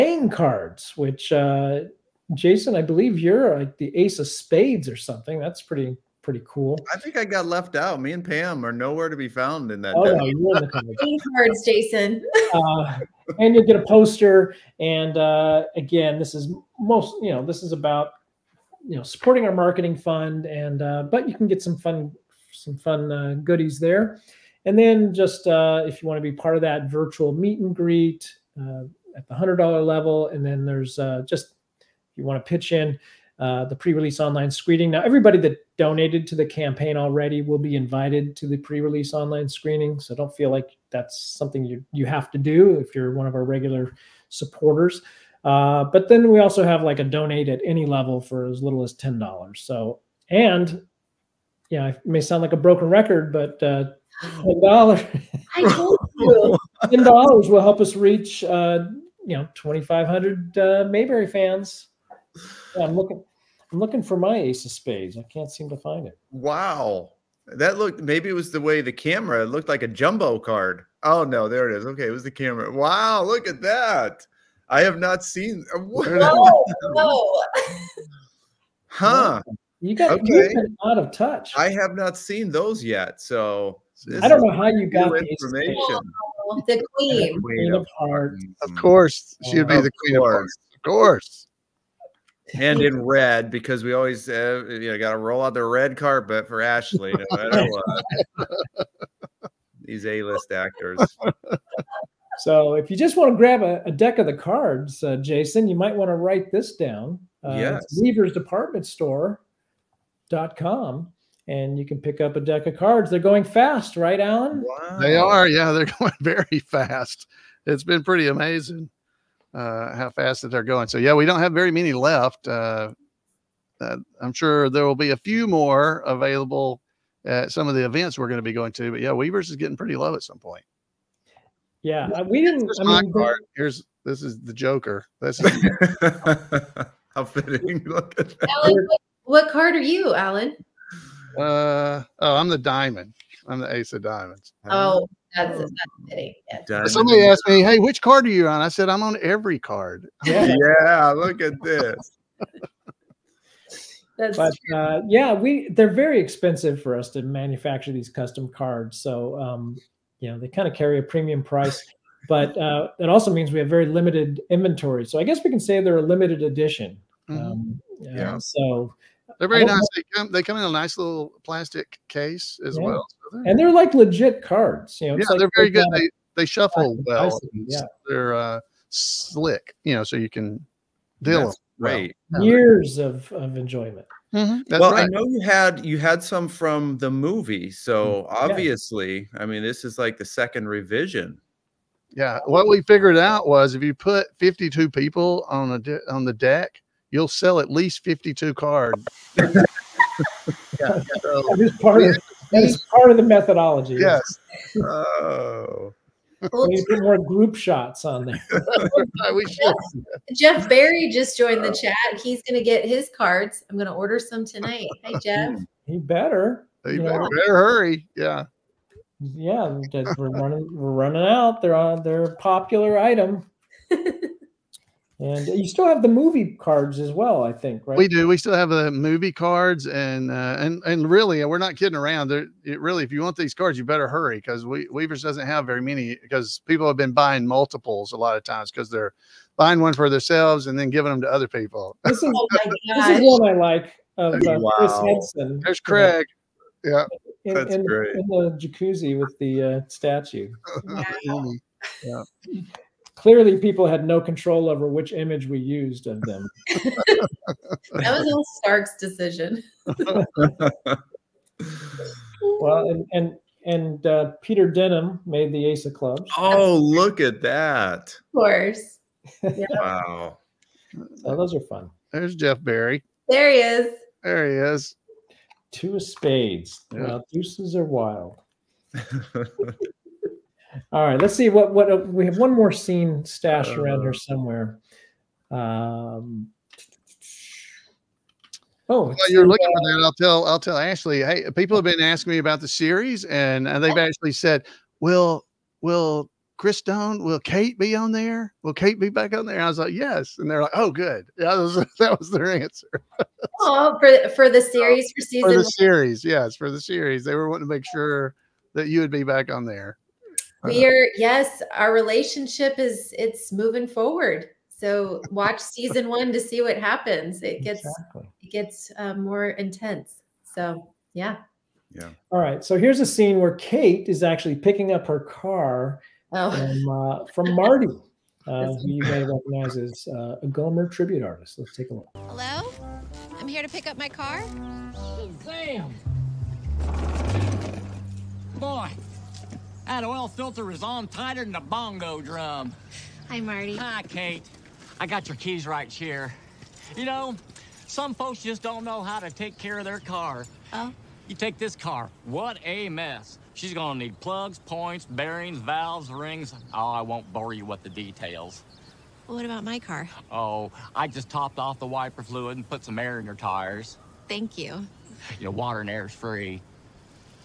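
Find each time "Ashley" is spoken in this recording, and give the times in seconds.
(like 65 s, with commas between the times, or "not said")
96 s, 290 s.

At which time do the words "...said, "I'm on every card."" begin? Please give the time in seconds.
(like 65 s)
148 s.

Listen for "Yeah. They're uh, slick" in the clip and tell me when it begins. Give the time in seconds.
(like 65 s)
177 s.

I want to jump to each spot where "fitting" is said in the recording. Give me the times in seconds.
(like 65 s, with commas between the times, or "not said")
137 s.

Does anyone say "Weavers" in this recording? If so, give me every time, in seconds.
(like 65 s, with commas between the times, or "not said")
107 s, 129 s, 234 s.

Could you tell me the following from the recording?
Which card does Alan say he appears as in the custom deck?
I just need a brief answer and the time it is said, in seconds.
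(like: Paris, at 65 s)
Ace of diamonds, at 143 s.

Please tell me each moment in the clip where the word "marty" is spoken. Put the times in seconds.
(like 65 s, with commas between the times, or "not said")
327 s, 343 s.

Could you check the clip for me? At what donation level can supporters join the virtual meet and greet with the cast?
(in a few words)
$100.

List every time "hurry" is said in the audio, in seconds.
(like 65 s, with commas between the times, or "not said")
217 s, 234 s.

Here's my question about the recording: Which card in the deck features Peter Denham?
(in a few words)
Ace of Clubs.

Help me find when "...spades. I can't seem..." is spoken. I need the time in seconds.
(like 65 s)
64 s.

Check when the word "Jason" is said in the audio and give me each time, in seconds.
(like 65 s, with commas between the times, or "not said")
2 s, 11 s, 105 s.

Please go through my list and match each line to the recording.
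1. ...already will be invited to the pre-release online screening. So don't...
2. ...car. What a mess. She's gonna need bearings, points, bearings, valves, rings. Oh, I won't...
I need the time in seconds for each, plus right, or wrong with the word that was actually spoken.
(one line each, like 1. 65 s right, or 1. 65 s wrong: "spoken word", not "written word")
1. 36 s right
2. 351 s wrong: "plugs", not "bearings".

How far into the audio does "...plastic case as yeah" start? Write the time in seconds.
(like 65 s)
171 s.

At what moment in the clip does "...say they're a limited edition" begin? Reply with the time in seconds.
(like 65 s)
165 s.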